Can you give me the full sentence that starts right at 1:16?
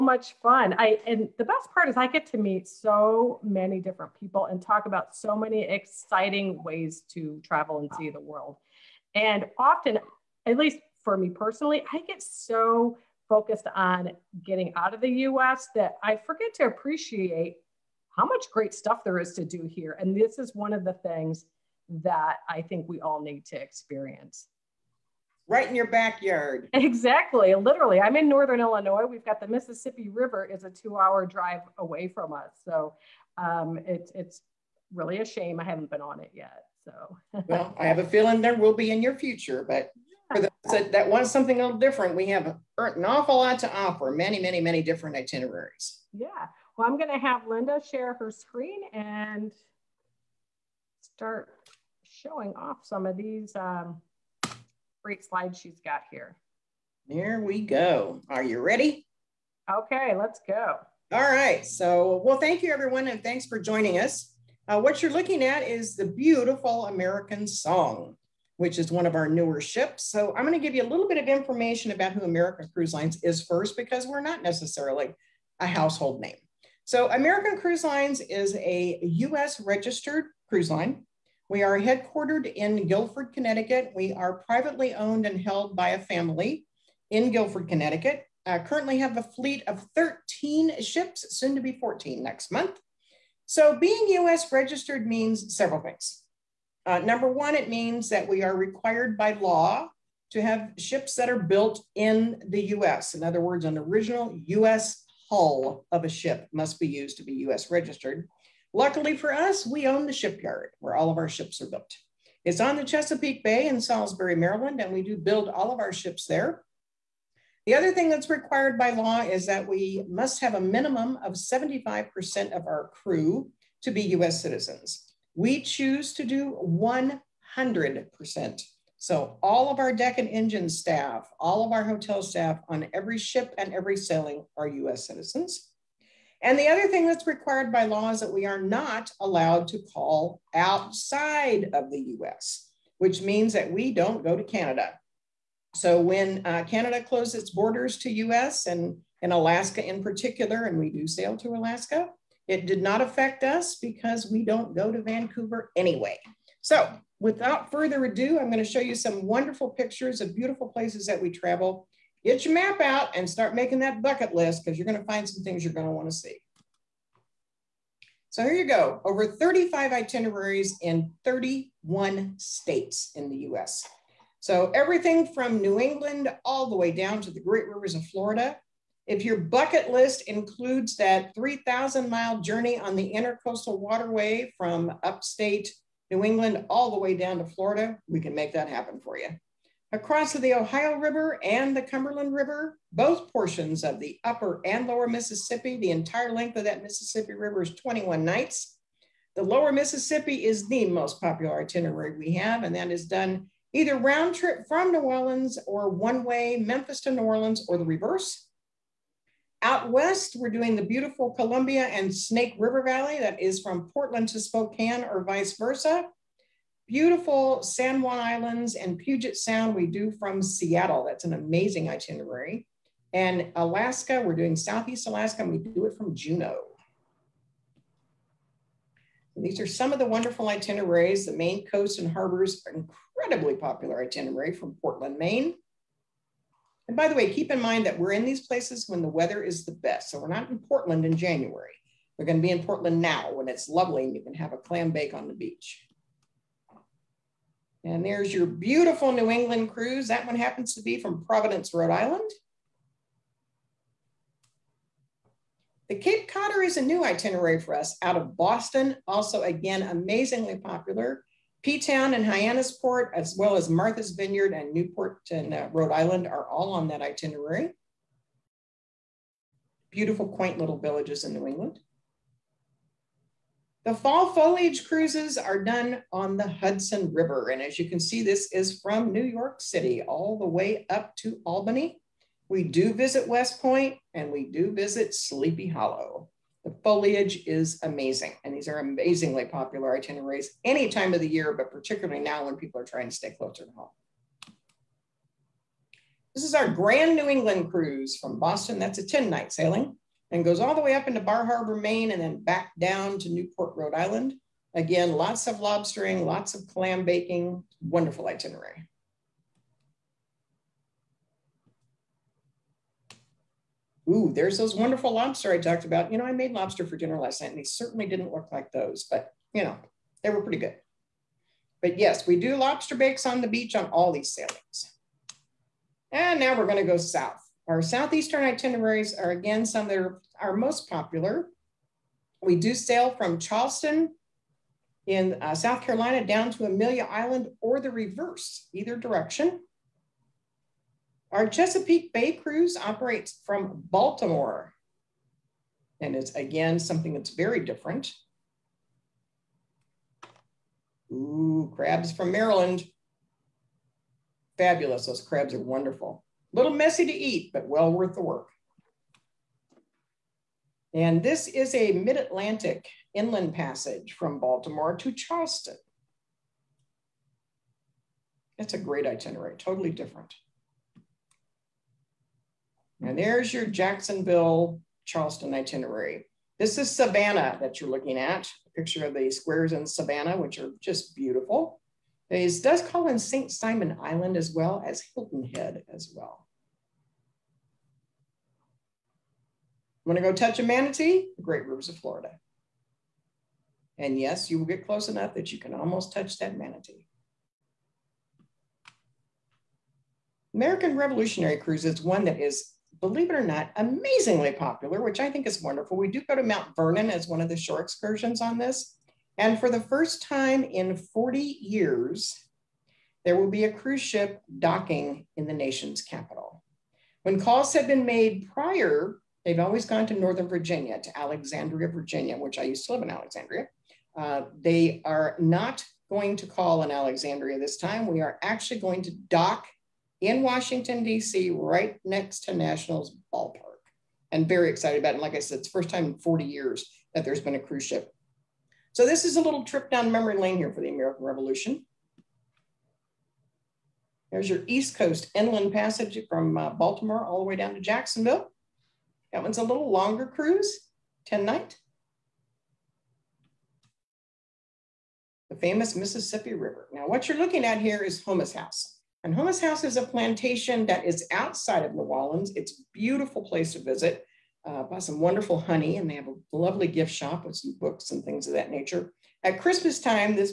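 So, American Cruise Lines is a US registered cruise line.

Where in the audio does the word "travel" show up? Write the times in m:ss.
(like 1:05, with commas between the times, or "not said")
0:07, 2:41.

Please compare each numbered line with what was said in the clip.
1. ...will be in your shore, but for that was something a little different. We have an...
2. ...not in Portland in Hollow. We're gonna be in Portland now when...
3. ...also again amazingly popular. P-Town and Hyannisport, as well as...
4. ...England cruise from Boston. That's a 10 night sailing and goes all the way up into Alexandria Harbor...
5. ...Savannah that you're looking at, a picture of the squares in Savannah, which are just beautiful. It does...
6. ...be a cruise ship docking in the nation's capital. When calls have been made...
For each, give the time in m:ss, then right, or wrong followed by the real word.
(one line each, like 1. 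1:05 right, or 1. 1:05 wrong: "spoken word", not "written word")
1. 0:38 wrong: "future", not "shore"
2. 4:00 wrong: "January", not "Hollow"
3. 4:19 right
4. 4:57 wrong: "Bar", not "Alexandria"
5. 6:16 right
6. 6:53 right.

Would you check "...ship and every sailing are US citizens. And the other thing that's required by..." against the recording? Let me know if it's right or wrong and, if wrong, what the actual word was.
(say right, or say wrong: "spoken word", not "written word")
right.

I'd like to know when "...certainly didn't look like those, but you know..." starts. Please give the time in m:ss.
5:17.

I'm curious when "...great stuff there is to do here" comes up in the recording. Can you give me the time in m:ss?
0:18.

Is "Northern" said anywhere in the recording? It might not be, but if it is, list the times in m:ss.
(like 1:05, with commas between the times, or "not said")
0:28, 7:00.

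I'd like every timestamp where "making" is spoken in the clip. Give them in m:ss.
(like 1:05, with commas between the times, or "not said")
2:43.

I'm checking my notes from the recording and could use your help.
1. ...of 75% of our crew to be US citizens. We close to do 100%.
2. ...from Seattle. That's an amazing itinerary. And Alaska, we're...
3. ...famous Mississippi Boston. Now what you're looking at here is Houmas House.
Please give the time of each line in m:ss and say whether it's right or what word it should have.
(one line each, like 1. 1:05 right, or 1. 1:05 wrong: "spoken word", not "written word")
1. 2:01 wrong: "choose", not "close"
2. 3:40 right
3. 7:35 wrong: "River", not "Boston".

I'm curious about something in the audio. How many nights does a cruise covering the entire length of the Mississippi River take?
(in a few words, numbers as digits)
21.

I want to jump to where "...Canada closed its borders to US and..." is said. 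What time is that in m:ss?
2:26.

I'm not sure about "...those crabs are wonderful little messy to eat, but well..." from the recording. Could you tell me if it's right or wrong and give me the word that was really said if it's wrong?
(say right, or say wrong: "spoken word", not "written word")
right.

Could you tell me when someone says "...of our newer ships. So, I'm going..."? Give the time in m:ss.
1:09.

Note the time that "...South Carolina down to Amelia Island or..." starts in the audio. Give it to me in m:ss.
5:35.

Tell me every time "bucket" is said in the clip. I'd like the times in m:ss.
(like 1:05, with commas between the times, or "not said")
2:44, 2:59.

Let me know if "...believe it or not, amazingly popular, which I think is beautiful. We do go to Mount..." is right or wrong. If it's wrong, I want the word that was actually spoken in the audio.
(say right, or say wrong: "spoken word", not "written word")
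wrong: "wonderful", not "beautiful".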